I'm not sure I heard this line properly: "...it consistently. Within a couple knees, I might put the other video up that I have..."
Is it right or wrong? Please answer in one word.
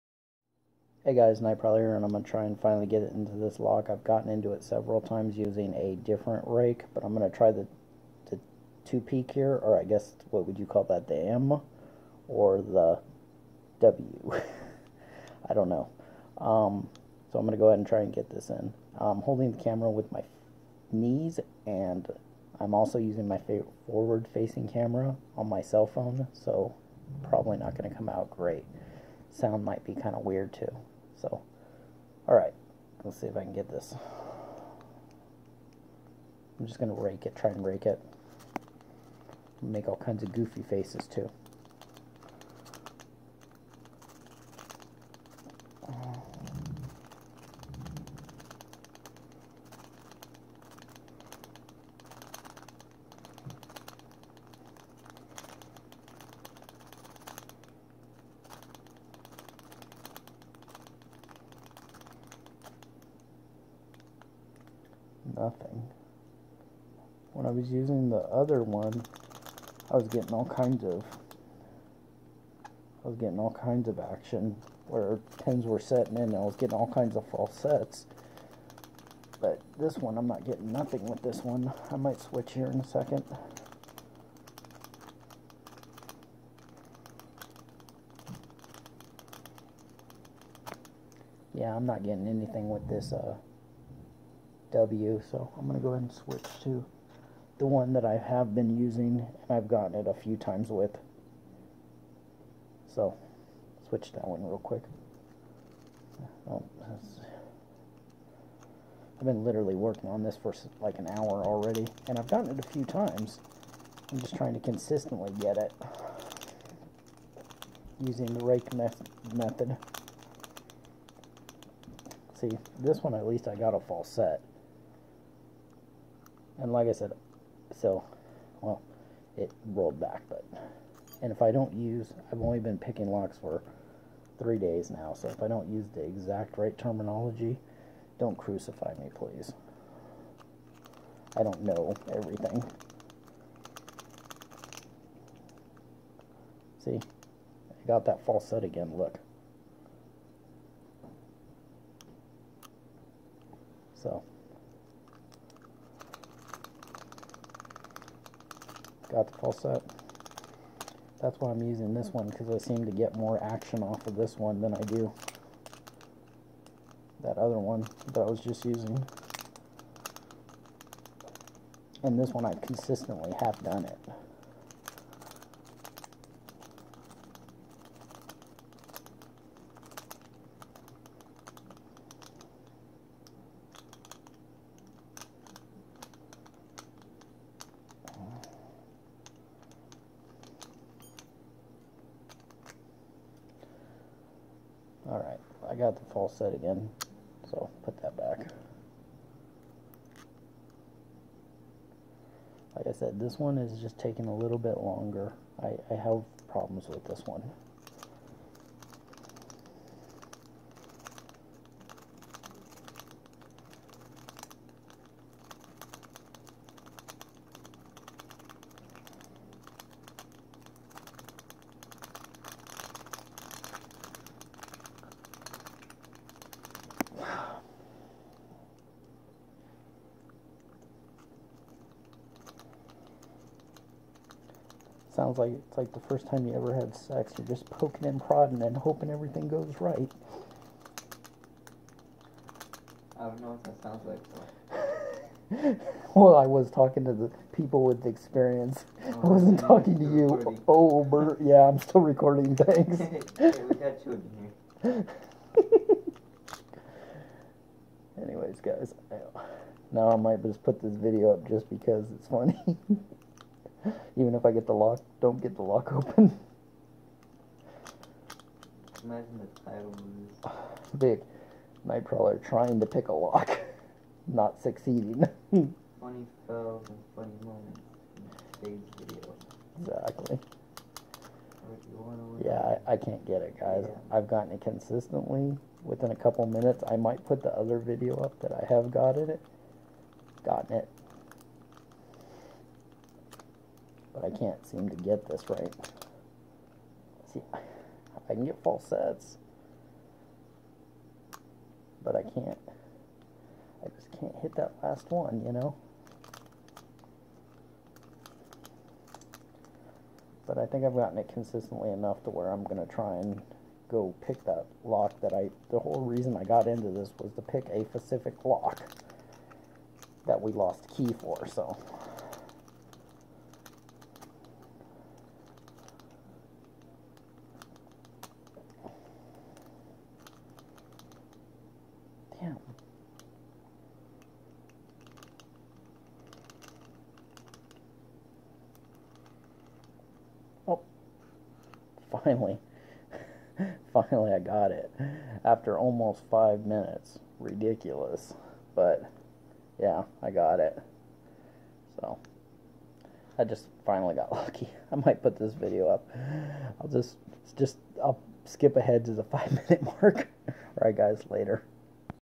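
wrong.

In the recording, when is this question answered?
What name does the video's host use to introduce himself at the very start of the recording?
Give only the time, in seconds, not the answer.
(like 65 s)
1 s.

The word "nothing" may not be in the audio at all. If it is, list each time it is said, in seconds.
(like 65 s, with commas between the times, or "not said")
65 s, 80 s.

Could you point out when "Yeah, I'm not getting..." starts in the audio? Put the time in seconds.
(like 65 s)
91 s.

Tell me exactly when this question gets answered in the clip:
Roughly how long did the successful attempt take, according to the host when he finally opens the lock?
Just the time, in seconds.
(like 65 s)
345 s.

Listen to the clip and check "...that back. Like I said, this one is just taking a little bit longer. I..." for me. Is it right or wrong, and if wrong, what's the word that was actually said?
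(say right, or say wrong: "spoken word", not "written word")
right.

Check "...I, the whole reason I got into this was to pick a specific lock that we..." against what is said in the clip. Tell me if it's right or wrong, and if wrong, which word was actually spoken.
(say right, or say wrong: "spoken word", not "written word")
right.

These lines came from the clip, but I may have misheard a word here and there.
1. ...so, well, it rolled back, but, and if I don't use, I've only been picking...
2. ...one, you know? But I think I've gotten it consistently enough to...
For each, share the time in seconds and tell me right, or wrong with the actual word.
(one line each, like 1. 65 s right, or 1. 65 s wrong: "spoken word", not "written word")
1. 127 s right
2. 305 s right.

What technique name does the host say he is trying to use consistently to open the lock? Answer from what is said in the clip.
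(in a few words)
rake me method.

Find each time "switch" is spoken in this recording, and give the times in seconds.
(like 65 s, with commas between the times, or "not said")
82 s, 96 s, 103 s.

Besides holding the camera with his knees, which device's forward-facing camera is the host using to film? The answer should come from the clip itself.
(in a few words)
cell phone.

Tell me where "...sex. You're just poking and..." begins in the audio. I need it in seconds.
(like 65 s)
236 s.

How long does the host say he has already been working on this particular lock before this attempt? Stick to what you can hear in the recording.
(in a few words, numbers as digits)
like an hour.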